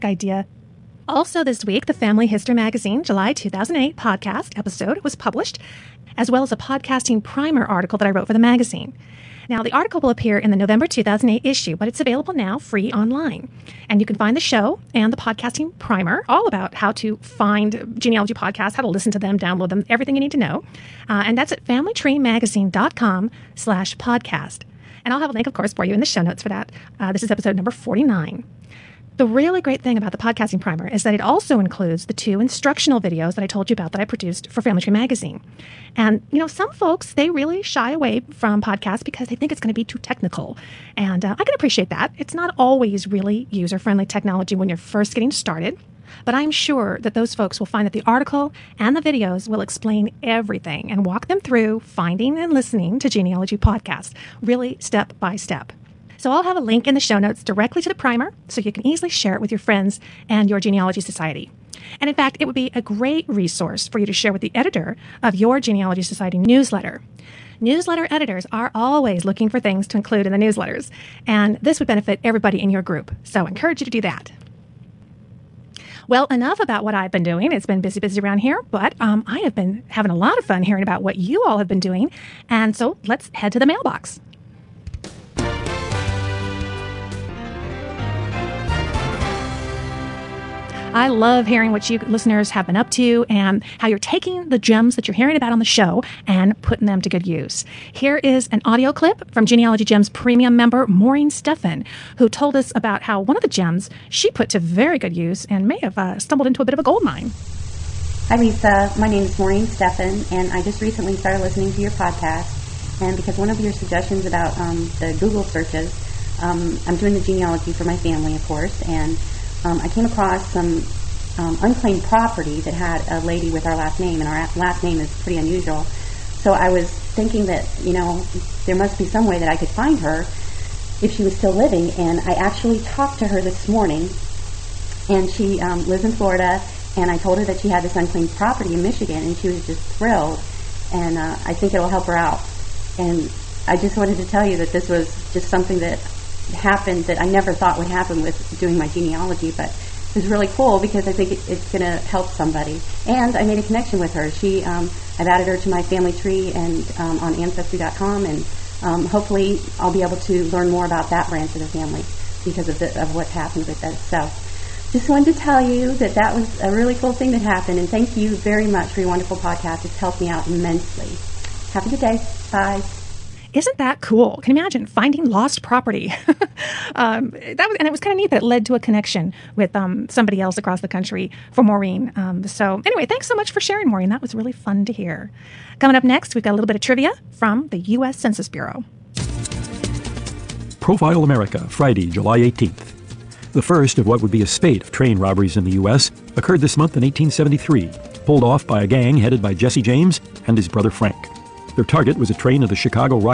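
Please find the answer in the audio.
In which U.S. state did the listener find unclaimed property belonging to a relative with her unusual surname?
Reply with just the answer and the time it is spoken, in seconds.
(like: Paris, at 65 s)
Michigan, at 138 s.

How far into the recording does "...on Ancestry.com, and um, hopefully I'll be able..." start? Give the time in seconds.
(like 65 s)
157 s.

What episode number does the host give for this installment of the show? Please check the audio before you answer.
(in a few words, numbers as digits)
49.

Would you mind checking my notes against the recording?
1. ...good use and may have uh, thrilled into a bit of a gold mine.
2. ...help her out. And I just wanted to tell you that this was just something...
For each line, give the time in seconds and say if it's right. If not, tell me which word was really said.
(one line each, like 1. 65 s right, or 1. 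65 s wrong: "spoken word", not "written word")
1. 104 s wrong: "stumbled", not "thrilled"
2. 141 s right.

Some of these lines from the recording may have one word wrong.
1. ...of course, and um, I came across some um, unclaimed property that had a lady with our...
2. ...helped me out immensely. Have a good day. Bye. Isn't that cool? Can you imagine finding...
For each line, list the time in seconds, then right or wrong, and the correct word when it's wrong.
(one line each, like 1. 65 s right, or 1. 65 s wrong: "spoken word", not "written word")
1. 118 s right
2. 169 s right.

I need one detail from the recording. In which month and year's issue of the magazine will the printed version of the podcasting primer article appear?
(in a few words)
November 2008.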